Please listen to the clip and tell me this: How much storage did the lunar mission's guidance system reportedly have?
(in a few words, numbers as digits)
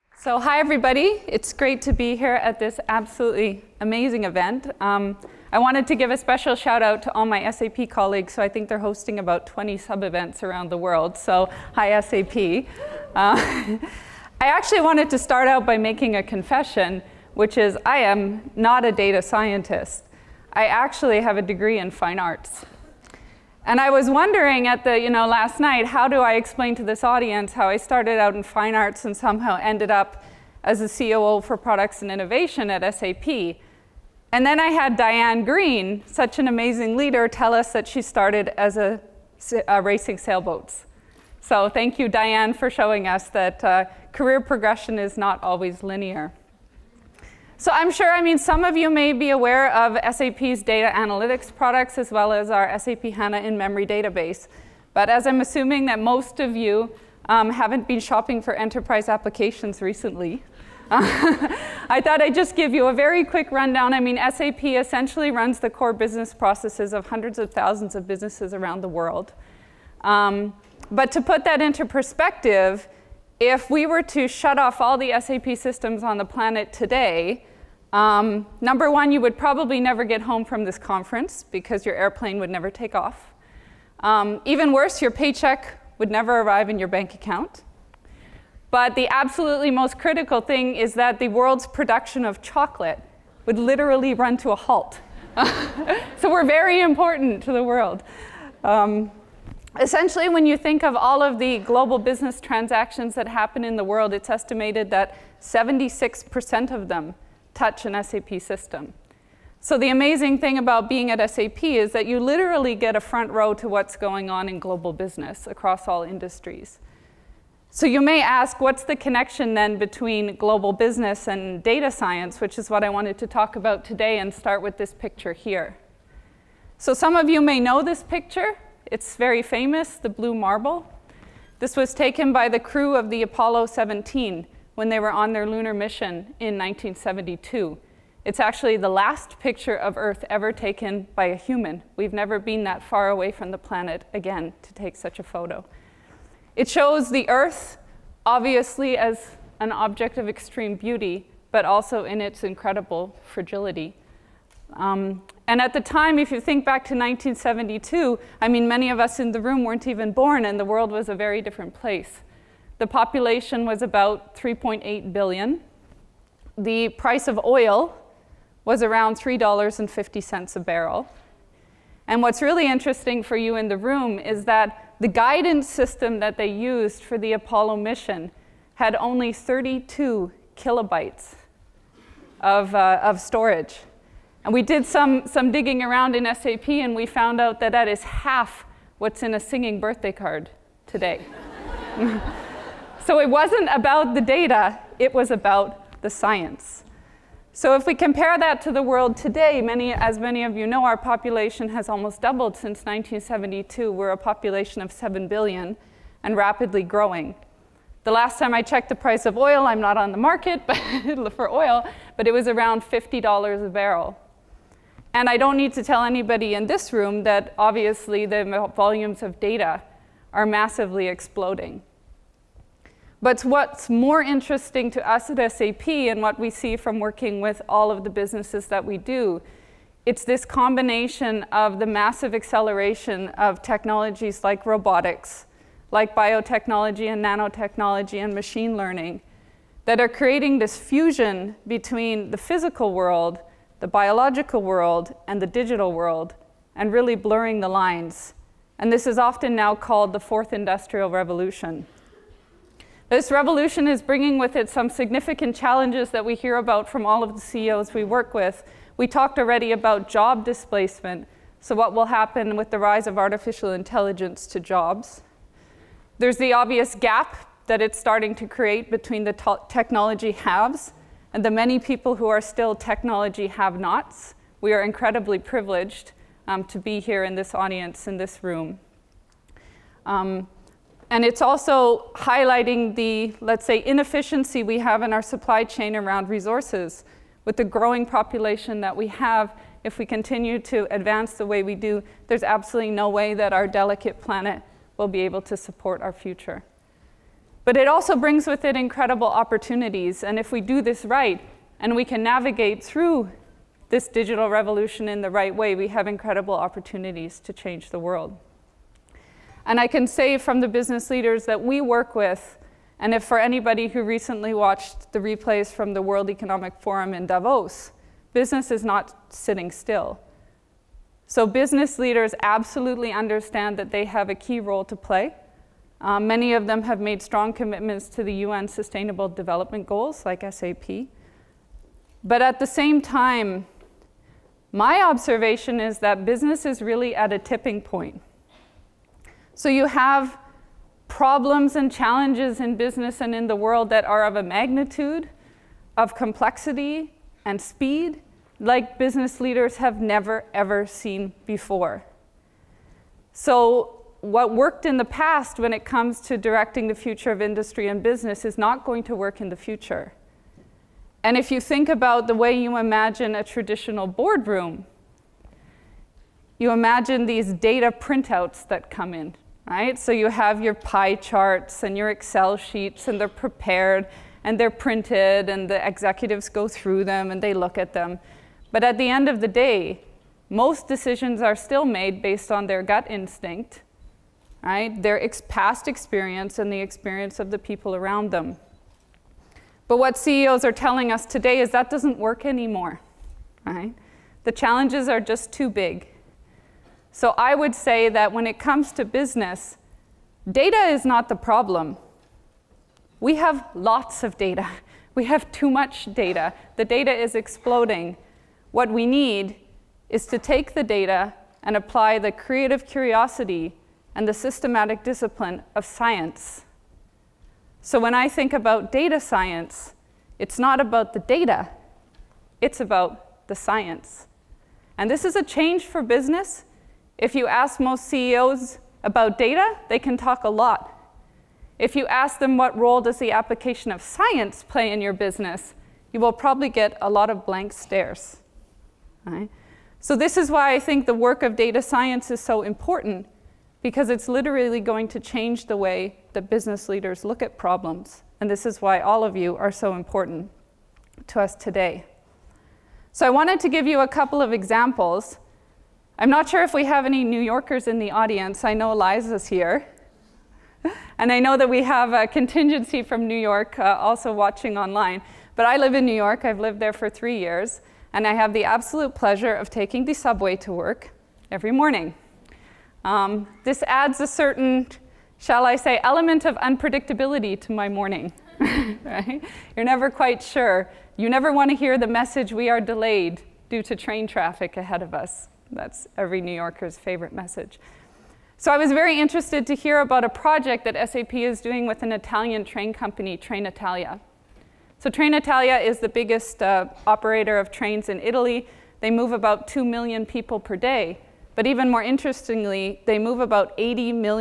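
32 kilobytes.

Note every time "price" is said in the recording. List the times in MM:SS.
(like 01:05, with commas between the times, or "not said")
02:46, 03:28.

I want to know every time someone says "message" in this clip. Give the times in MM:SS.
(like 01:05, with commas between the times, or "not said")
08:02, 08:07.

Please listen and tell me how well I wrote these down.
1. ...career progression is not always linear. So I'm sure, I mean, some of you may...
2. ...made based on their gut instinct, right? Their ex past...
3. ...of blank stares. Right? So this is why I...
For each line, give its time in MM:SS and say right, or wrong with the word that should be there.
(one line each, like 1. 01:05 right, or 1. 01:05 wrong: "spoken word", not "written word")
1. 00:44 right
2. 06:21 right
3. 07:17 right.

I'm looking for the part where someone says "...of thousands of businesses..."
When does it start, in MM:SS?
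01:07.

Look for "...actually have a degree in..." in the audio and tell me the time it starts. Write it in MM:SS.
00:20.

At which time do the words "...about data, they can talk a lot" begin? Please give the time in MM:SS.
07:09.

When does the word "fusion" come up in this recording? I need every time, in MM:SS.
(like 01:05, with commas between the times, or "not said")
04:00.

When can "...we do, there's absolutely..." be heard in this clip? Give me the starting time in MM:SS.
04:51.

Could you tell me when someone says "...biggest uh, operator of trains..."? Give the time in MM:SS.
08:16.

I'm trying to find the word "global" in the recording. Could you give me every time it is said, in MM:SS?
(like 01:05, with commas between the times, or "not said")
01:41, 01:54, 02:00.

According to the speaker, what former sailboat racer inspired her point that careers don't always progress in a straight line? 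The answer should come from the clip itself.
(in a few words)
Diane Greene.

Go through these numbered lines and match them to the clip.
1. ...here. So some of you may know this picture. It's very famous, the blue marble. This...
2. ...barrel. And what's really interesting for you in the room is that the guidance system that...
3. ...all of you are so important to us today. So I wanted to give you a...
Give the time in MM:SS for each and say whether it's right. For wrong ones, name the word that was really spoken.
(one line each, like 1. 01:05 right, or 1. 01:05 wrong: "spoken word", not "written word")
1. 02:05 right
2. 02:50 right
3. 07:28 right.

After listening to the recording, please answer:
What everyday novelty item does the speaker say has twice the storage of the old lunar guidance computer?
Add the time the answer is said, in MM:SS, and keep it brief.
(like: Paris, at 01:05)
Singing birthday card, at 03:09.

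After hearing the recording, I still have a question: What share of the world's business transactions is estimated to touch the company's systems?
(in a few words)
76%.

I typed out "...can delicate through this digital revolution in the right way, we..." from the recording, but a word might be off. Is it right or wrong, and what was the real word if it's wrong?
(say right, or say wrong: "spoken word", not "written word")
wrong: "navigate", not "delicate".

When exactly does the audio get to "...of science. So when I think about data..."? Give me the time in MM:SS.
06:55.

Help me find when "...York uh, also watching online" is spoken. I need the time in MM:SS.
07:43.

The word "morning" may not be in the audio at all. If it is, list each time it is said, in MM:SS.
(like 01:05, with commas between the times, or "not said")
07:51, 07:57.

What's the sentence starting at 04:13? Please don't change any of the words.
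This revolution is bringing with it some significant challenges that we hear about from all of the CEOs we work with.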